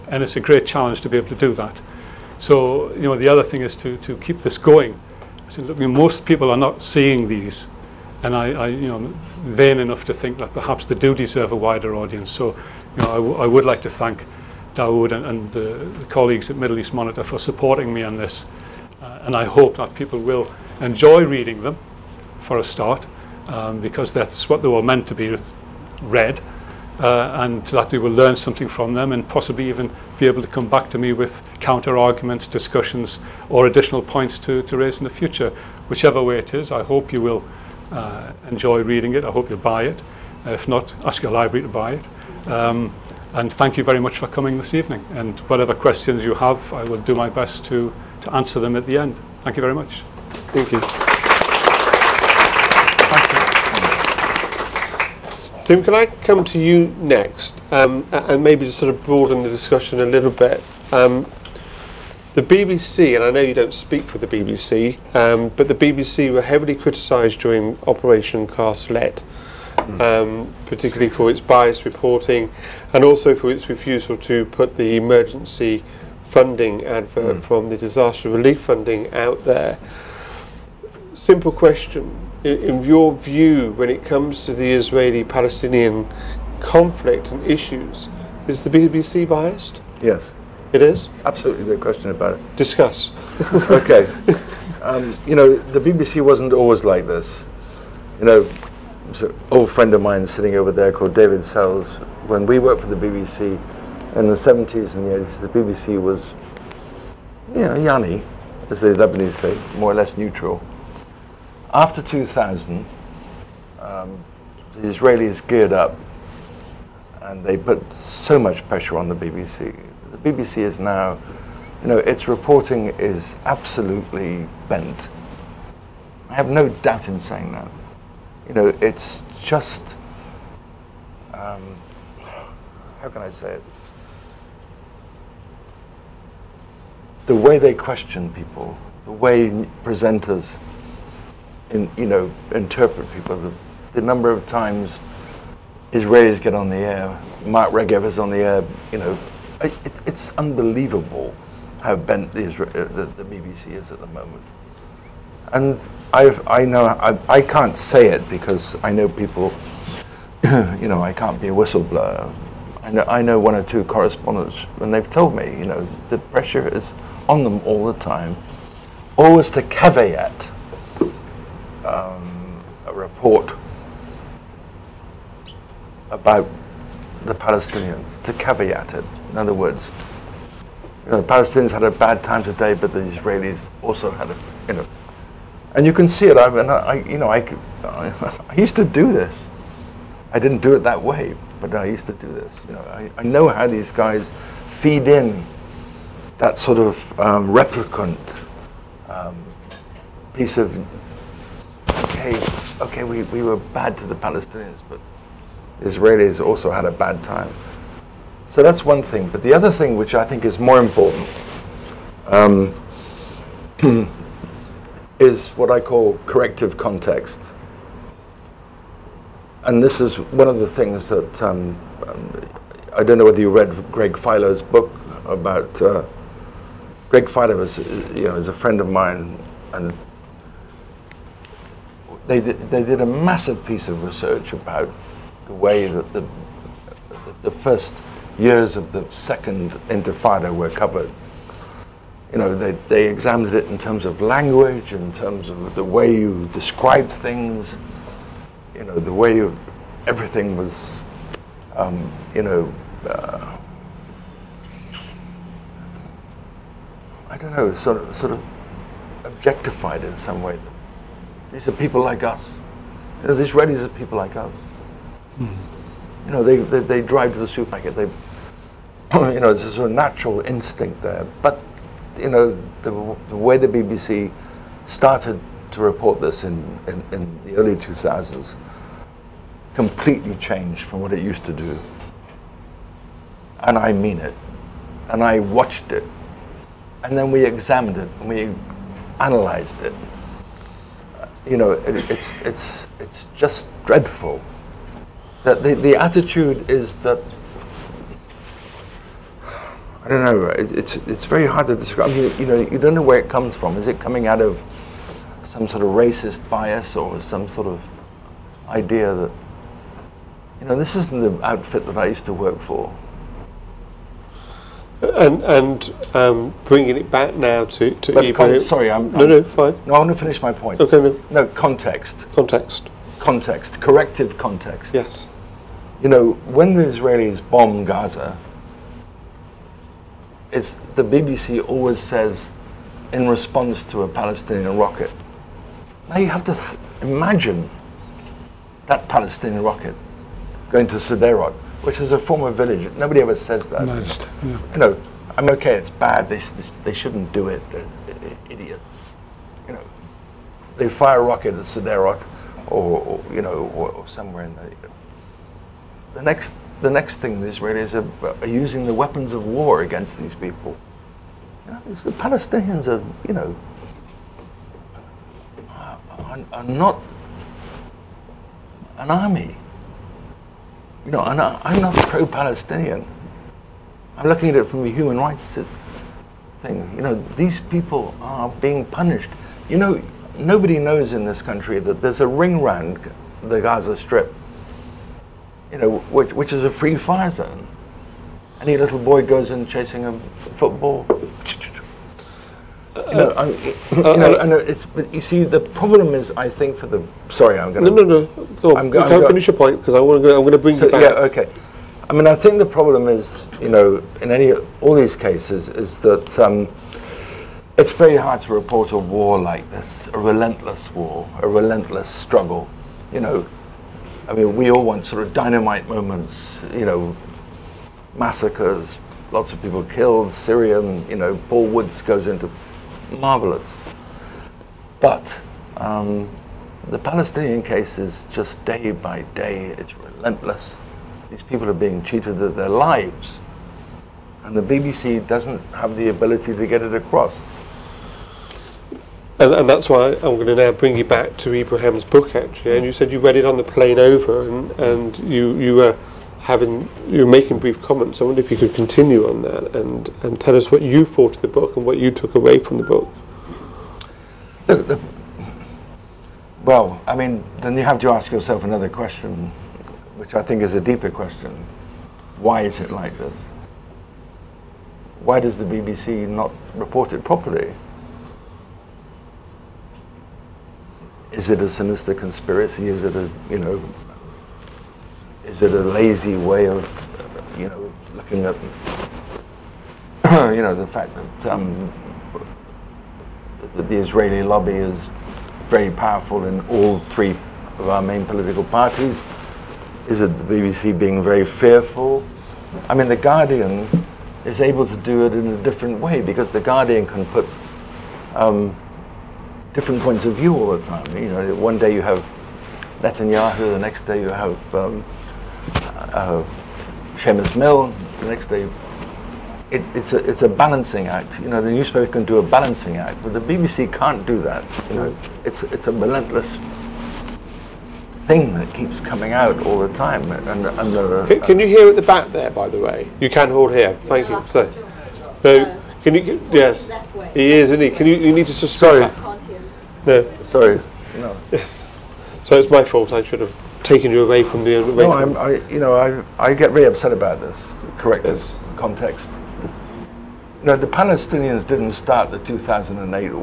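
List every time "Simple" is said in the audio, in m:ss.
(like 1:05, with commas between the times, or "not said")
1:21.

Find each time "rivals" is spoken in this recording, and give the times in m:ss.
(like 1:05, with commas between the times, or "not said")
not said.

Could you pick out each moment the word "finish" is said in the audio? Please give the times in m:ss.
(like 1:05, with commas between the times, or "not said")
5:20, 6:39.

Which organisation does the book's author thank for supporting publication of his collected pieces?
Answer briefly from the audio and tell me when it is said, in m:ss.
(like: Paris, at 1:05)
Middle East Monitor, at 0:16.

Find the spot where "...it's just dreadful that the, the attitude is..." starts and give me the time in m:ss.
4:52.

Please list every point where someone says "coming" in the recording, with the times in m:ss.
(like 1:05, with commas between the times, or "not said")
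0:44, 5:03, 8:38.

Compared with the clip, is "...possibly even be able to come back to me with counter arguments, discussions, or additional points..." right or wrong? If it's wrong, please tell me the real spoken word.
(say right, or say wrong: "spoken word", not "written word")
right.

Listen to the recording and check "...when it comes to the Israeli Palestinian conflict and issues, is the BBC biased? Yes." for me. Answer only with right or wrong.
right.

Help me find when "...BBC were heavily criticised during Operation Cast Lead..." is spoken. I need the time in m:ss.
1:05.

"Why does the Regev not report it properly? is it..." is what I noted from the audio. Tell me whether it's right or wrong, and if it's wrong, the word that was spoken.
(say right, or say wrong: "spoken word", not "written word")
wrong: "BBC", not "Regev".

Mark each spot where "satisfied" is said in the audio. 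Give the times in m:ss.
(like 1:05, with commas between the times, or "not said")
not said.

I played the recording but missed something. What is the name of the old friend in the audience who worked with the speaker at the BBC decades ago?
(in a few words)
David Sells.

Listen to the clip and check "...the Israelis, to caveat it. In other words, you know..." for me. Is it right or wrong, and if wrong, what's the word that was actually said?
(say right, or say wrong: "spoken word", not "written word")
wrong: "Palestinians", not "Israelis".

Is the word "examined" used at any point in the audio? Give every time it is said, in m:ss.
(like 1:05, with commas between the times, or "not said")
4:03, 4:47.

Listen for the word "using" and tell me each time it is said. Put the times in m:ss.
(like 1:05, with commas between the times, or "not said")
5:58.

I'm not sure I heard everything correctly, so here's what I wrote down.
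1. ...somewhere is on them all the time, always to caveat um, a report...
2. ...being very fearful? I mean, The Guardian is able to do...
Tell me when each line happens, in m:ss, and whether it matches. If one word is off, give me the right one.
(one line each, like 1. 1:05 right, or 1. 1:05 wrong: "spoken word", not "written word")
1. 2:46 wrong: "pressure", not "somewhere"
2. 8:10 right.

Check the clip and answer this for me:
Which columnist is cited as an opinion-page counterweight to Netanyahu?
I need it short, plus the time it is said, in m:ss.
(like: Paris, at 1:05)
Seumas Milne, at 8:27.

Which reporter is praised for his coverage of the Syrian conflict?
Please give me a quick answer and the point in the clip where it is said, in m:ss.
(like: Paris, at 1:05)
Paul Woods, at 7:01.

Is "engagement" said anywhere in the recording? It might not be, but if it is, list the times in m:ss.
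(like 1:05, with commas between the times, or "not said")
not said.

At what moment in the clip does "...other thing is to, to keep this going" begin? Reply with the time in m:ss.
0:03.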